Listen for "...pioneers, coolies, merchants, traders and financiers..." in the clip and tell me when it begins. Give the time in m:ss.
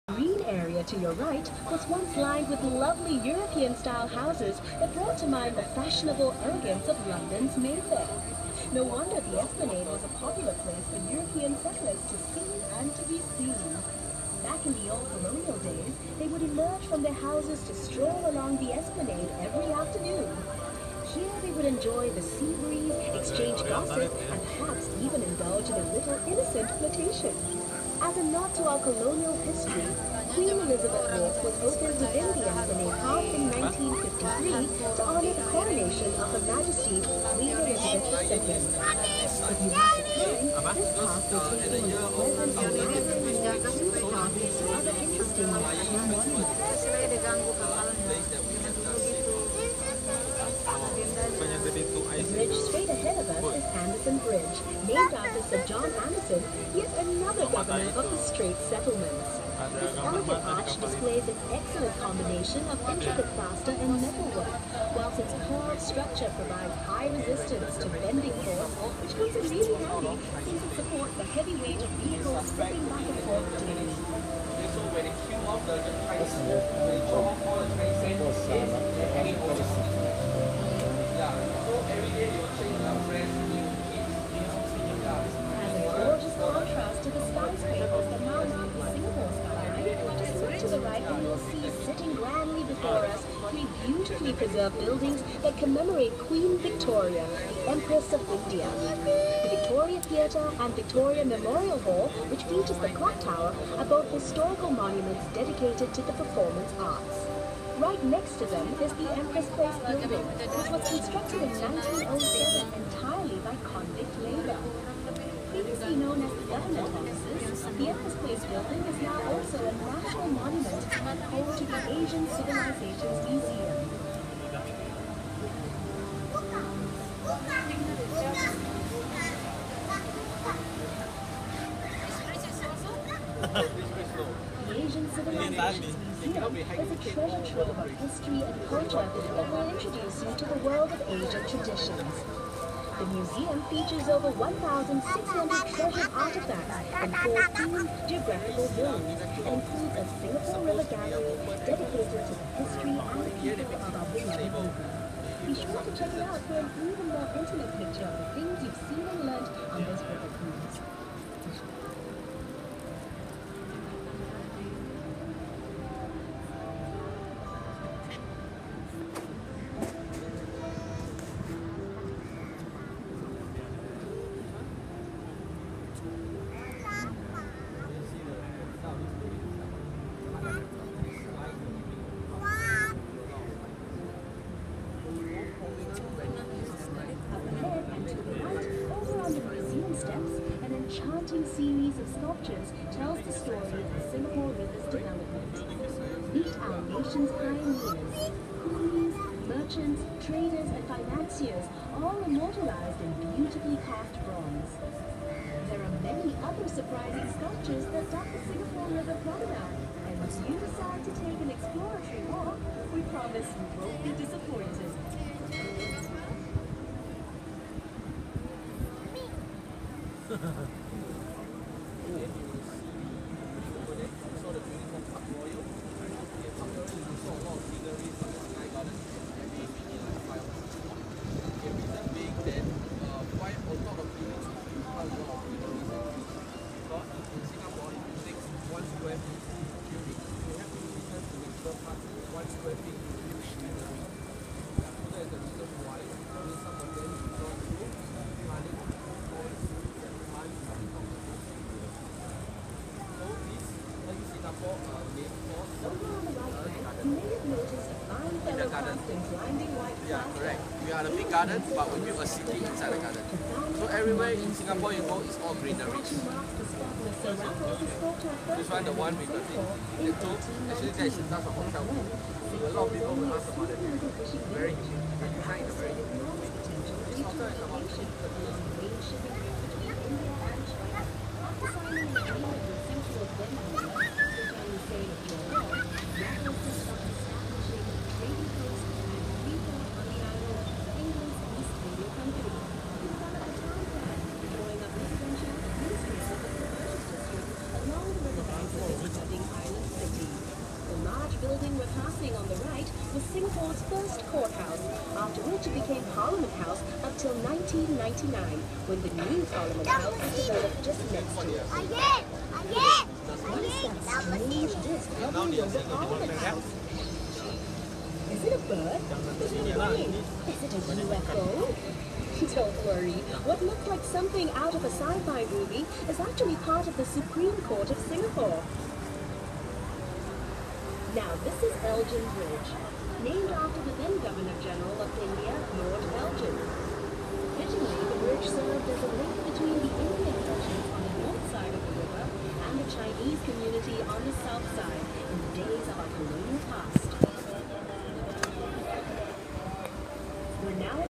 3:17.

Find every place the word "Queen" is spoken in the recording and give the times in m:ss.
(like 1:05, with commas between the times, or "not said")
0:30, 0:37, 1:36.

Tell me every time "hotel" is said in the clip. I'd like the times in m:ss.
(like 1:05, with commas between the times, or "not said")
4:31, 4:37.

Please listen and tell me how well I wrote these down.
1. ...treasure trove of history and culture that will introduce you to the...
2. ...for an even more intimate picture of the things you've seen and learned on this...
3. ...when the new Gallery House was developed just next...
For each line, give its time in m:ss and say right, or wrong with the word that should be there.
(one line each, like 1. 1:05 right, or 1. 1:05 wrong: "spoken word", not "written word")
1. 2:17 right
2. 2:36 right
3. 5:08 wrong: "Parliament", not "Gallery".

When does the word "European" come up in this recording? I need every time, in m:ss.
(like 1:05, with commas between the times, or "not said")
0:03, 0:11.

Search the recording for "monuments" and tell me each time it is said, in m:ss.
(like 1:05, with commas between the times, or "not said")
1:44, 2:00.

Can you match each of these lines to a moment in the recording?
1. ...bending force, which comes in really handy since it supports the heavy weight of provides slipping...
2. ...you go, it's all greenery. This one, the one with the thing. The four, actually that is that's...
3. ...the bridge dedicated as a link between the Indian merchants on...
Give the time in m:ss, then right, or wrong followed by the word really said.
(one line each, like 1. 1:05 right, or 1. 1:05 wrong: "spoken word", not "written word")
1. 1:07 wrong: "vehicles", not "provides"
2. 4:24 wrong: "two", not "four"
3. 5:38 wrong: "served", not "dedicated".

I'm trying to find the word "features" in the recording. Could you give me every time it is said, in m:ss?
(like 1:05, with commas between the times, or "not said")
1:42, 2:23.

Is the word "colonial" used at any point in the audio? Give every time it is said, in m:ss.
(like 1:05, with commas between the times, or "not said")
0:15, 0:28, 5:46.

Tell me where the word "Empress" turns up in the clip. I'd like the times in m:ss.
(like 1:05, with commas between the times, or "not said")
1:37, 1:49, 1:57.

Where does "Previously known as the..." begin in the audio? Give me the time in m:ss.
1:55.